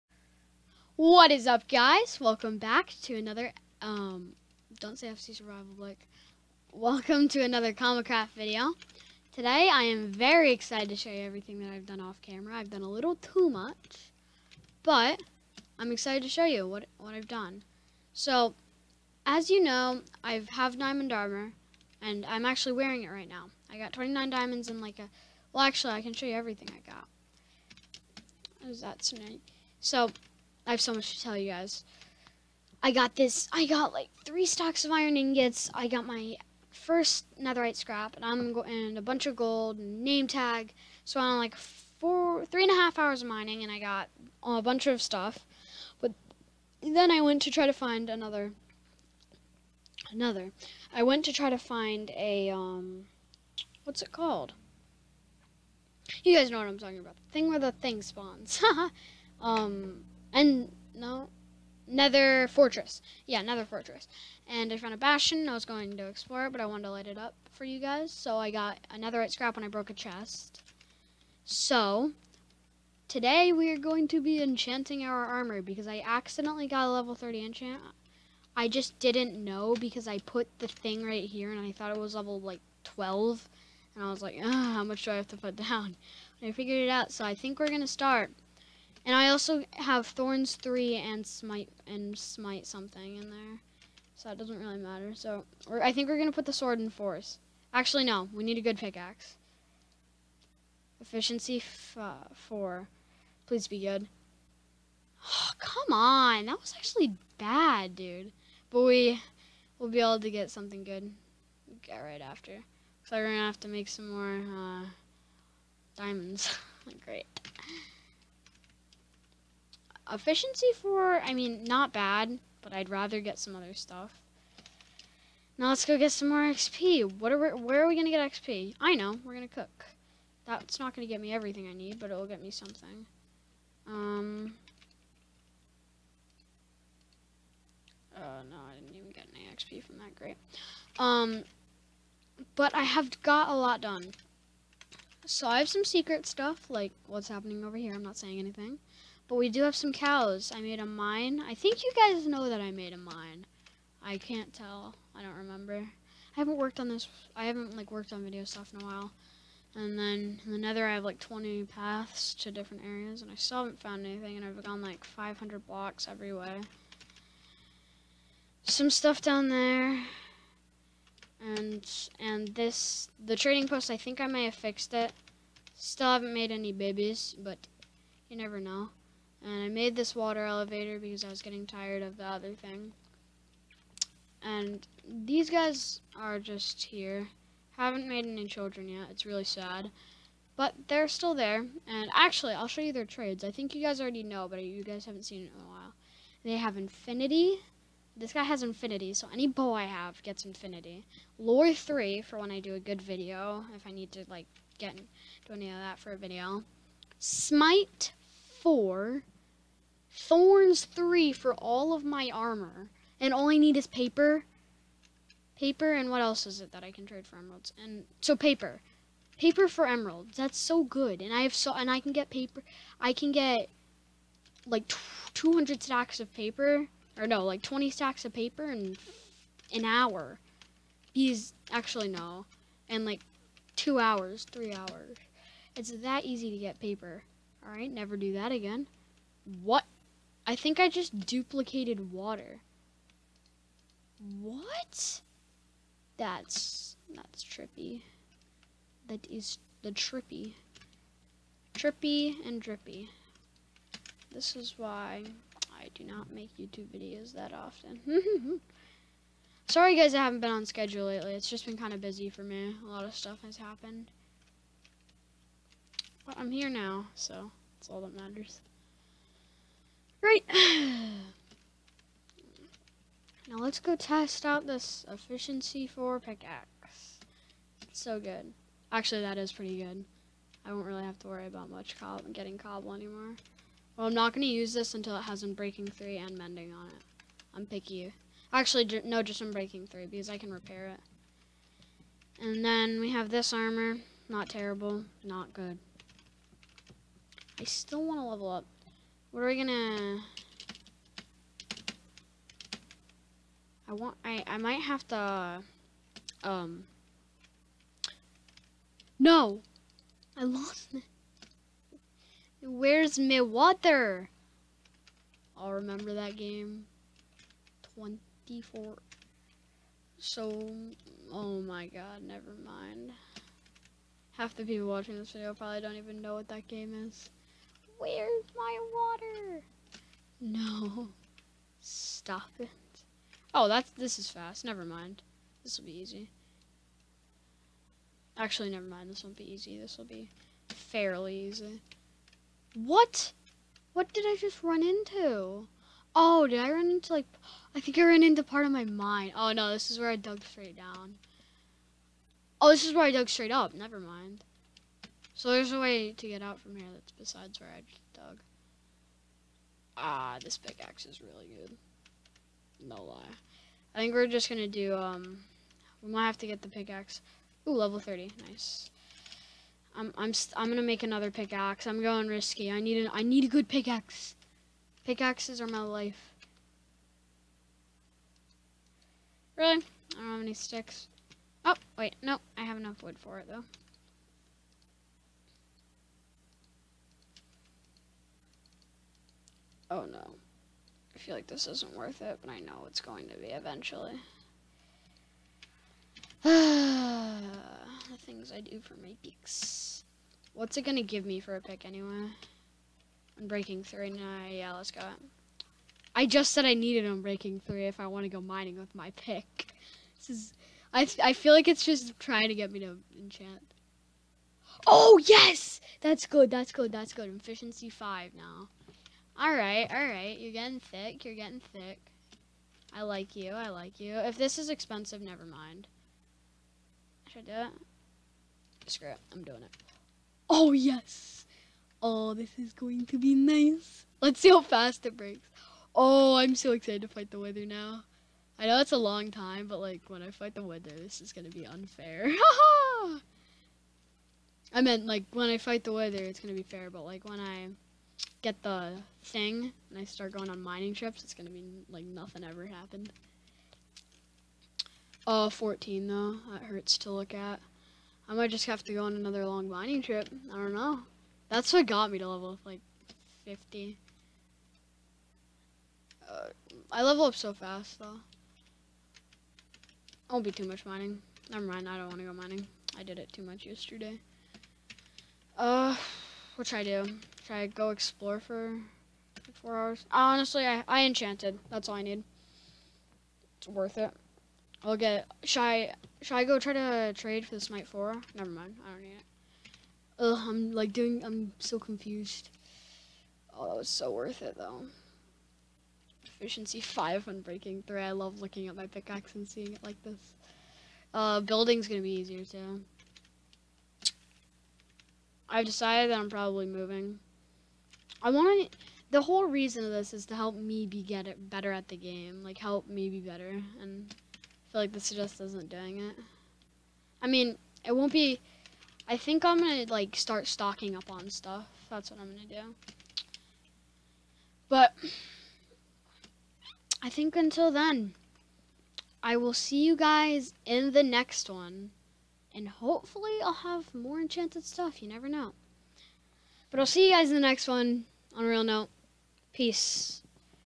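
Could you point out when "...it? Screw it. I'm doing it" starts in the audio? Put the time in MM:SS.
07:07.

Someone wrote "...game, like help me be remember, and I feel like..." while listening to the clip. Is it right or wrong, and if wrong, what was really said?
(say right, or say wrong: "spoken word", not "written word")
wrong: "better", not "remember".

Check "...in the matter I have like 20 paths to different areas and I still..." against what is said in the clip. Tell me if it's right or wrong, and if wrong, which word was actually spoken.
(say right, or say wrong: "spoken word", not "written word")
wrong: "nether", not "matter".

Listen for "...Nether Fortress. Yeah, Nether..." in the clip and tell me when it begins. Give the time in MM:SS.
01:01.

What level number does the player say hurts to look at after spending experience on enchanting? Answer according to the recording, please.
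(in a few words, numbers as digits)
14.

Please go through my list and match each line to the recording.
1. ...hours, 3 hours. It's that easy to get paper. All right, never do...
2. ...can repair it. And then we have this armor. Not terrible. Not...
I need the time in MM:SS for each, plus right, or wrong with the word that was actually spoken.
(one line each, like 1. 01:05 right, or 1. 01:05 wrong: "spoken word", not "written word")
1. 03:53 right
2. 04:50 right.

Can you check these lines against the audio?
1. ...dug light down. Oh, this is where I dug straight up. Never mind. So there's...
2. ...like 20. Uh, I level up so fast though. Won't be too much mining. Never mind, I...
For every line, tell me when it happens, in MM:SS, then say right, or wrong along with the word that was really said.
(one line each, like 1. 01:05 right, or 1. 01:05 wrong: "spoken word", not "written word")
1. 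05:50 wrong: "straight", not "light"
2. 07:42 wrong: "50", not "20".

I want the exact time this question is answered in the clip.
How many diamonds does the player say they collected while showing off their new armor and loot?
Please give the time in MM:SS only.
00:23.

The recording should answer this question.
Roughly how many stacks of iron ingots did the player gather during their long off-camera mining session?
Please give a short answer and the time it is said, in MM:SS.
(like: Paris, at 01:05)
3, at 00:34.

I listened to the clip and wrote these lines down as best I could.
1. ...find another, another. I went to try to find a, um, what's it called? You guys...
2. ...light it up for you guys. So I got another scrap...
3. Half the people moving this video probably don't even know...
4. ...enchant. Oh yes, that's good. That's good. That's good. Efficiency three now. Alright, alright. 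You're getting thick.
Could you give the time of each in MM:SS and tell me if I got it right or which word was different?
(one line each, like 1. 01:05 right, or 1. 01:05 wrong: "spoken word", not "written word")
1. 00:47 right
2. 01:06 right
3. 05:24 wrong: "watching", not "moving"
4. 06:53 wrong: "five", not "three".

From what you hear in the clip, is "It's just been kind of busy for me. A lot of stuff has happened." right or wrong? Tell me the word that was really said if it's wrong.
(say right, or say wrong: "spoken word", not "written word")
right.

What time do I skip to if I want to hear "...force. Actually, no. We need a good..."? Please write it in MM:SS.
01:36.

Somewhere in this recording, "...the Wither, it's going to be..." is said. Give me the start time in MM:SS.
07:25.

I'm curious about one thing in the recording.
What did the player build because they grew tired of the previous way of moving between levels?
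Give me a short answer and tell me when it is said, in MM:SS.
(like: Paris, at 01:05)
water elevator, at 03:00.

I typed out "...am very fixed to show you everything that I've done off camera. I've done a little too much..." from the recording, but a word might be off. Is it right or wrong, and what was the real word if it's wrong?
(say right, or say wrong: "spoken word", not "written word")
wrong: "excited", not "fixed".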